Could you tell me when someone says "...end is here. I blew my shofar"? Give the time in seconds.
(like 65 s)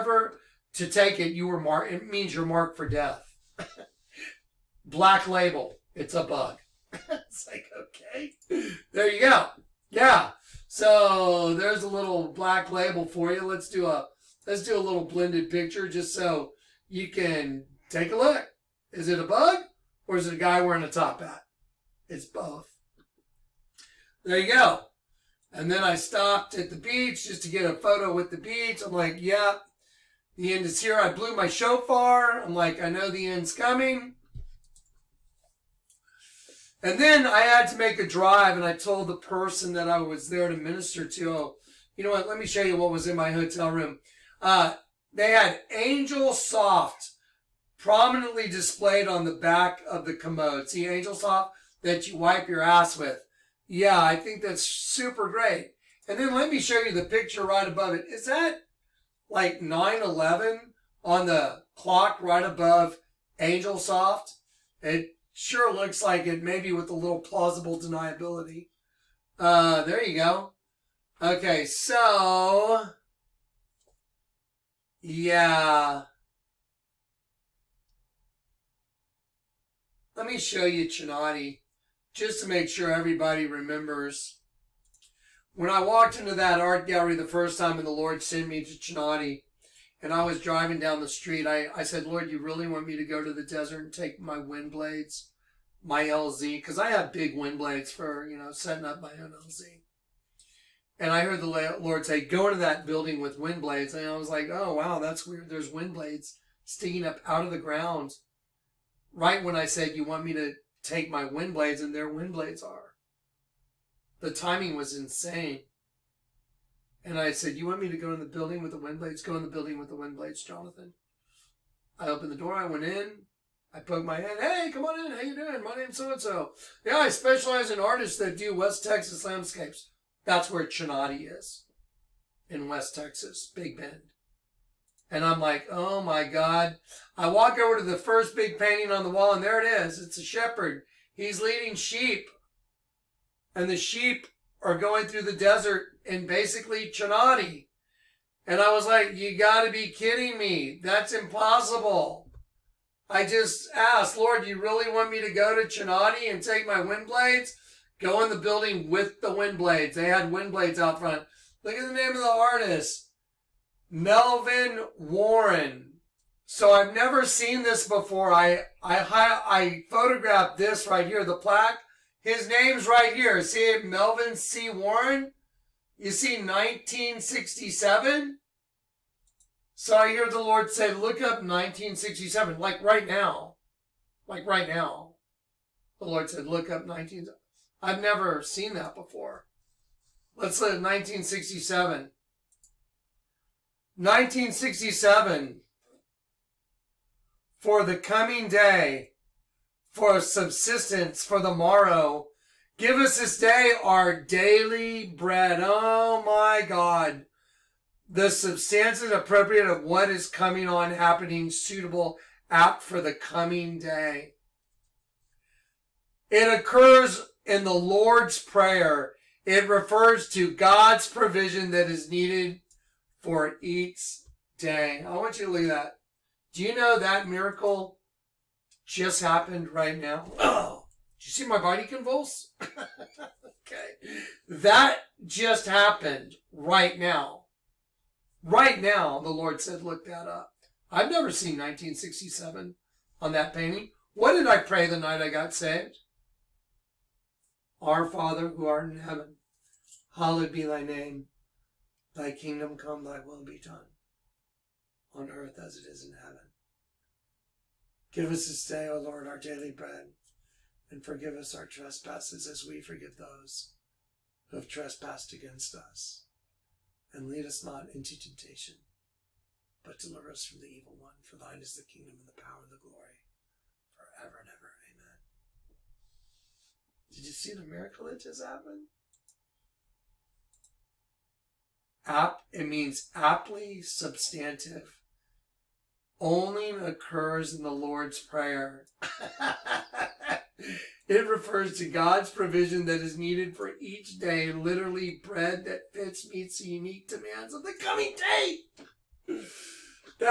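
30 s.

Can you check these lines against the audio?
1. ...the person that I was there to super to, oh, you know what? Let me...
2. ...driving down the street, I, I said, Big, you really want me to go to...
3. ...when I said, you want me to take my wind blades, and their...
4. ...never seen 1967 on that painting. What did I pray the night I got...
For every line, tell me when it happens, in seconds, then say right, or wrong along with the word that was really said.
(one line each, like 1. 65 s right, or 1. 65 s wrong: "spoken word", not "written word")
1. 39 s wrong: "minister", not "super"
2. 90 s wrong: "Lord", not "Big"
3. 109 s right
4. 241 s right.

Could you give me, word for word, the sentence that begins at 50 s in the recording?
See, Angel Soft that you wipe your ass with.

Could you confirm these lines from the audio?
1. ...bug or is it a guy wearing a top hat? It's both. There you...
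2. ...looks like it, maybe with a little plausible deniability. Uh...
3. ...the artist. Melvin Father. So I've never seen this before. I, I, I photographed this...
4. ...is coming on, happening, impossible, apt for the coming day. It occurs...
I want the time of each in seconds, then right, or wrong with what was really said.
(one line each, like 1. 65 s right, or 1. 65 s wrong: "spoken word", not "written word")
1. 19 s right
2. 65 s right
3. 162 s wrong: "Warren", not "Father"
4. 210 s wrong: "suitable", not "impossible".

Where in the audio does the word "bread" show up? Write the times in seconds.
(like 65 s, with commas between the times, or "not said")
205 s, 259 s, 295 s.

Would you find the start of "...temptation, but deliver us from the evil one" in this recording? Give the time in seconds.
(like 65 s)
268 s.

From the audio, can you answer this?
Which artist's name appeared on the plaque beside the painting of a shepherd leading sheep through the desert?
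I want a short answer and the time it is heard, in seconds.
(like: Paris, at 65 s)
Melvin C. Warren, at 173 s.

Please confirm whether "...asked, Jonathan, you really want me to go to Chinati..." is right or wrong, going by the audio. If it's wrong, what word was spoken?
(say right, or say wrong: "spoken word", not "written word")
wrong: "Lord", not "Jonathan".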